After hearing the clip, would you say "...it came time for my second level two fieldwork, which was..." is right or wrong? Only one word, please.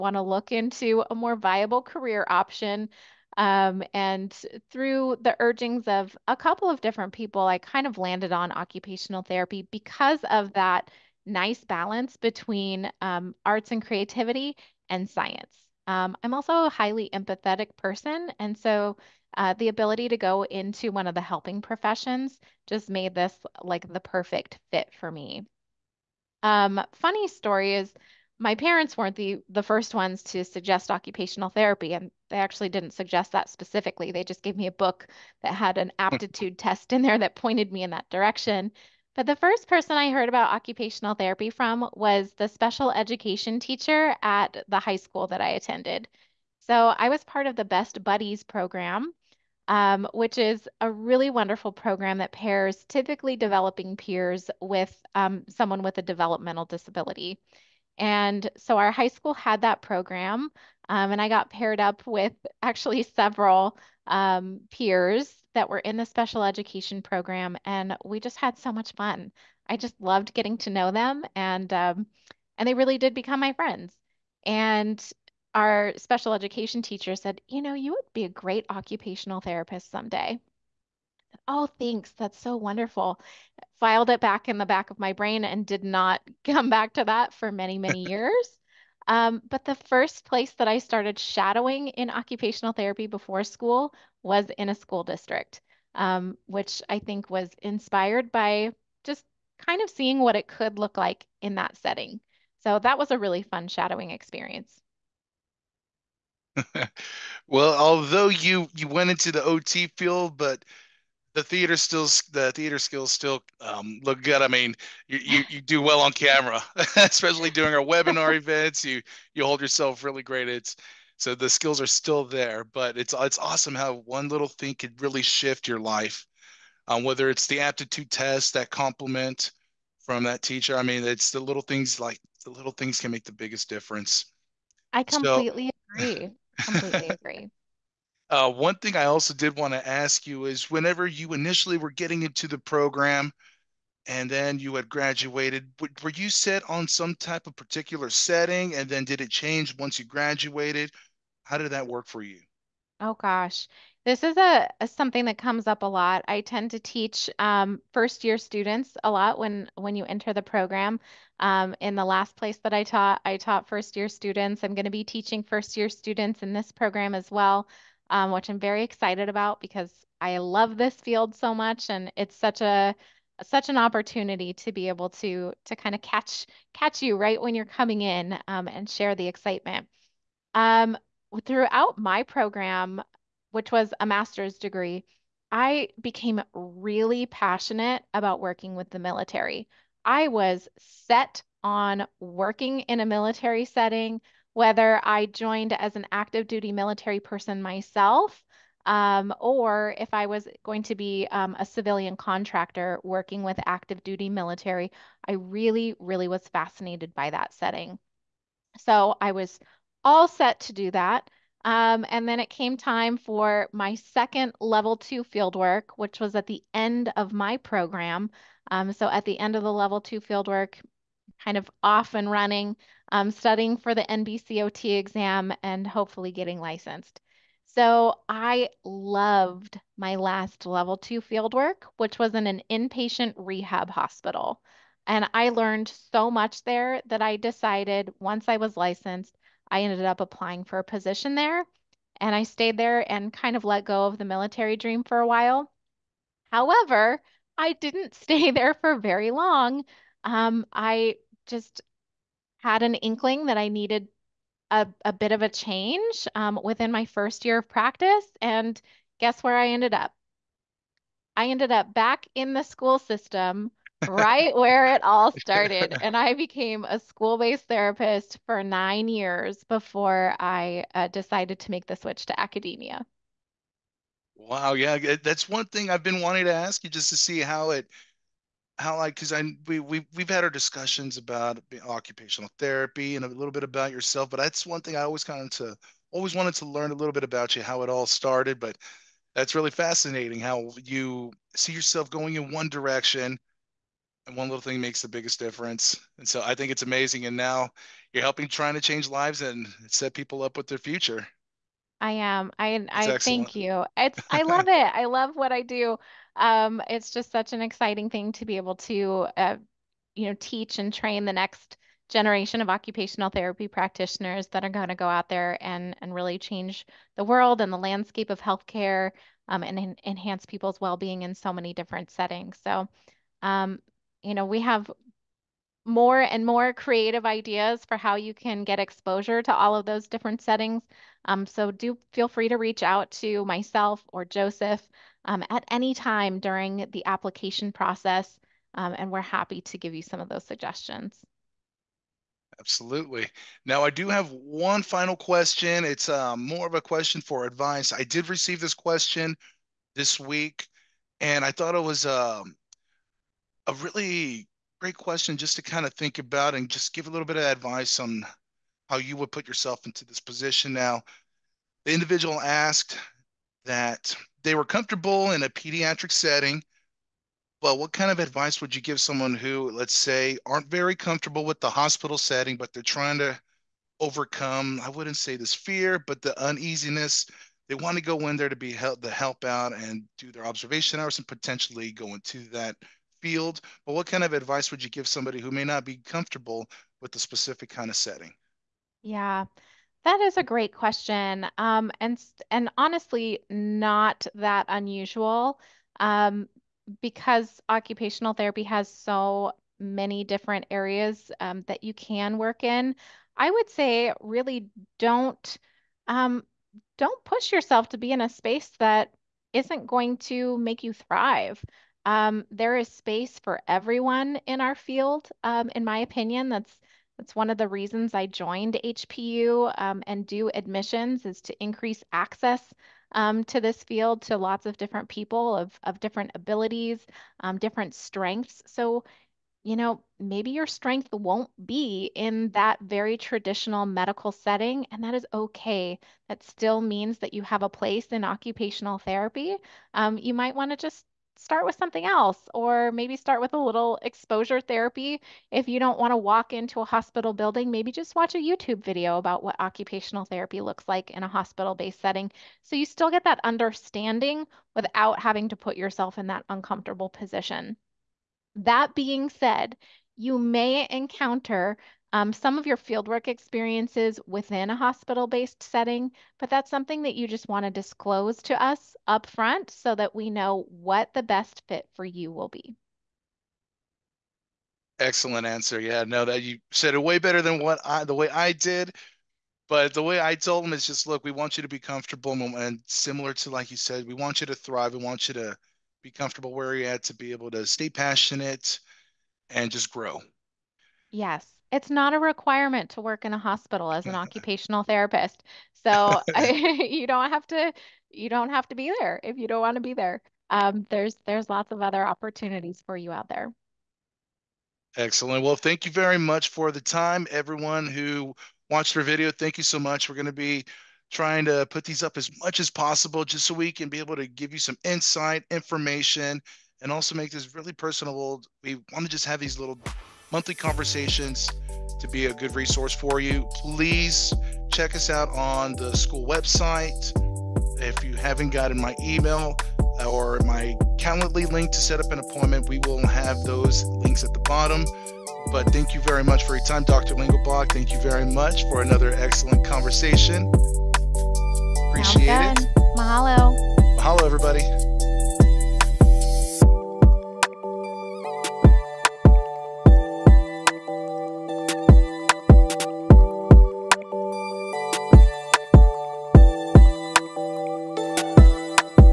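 right.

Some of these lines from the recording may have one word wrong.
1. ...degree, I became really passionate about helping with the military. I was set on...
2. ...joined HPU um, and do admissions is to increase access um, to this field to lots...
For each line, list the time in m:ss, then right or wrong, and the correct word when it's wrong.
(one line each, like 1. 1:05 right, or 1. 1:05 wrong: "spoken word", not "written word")
1. 3:04 wrong: "working", not "helping"
2. 6:58 right.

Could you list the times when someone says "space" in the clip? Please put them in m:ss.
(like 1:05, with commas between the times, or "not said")
6:48, 6:52.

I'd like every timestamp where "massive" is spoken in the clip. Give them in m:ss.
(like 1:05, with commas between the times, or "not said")
not said.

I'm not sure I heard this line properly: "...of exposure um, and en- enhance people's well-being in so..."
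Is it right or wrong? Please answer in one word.
wrong.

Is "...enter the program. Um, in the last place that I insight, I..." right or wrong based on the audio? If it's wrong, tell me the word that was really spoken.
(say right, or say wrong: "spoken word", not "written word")
wrong: "taught", not "insight".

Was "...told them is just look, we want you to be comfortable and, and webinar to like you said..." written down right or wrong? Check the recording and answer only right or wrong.
wrong.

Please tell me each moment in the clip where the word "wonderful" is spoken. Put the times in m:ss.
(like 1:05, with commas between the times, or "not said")
0:51, 1:22.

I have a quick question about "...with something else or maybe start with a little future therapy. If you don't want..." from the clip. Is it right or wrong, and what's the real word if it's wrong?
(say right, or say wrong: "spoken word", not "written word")
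wrong: "exposure", not "future".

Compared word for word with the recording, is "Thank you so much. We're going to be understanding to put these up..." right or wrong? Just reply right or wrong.
wrong.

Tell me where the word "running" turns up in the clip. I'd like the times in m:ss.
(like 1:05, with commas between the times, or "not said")
3:42.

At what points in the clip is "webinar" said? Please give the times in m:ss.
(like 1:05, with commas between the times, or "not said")
1:57.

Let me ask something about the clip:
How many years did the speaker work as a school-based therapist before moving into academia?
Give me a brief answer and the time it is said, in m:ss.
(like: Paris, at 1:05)
9, at 4:28.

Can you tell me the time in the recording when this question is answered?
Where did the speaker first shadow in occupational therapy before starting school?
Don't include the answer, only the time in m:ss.
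1:34.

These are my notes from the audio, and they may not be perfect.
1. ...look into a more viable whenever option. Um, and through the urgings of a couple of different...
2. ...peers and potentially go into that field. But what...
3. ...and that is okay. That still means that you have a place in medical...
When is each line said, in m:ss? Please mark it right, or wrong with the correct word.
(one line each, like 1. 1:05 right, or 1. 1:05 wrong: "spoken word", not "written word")
1. 0:00 wrong: "career", not "whenever"
2. 6:21 wrong: "hours", not "peers"
3. 7:14 wrong: "occupational", not "medical".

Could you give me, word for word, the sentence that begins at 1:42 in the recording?
So that was a really fun shadowing experience.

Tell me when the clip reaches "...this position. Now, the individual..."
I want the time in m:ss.
6:00.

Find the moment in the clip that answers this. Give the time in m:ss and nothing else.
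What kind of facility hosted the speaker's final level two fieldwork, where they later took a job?
3:52.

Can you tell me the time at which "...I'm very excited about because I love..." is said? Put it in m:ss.
2:48.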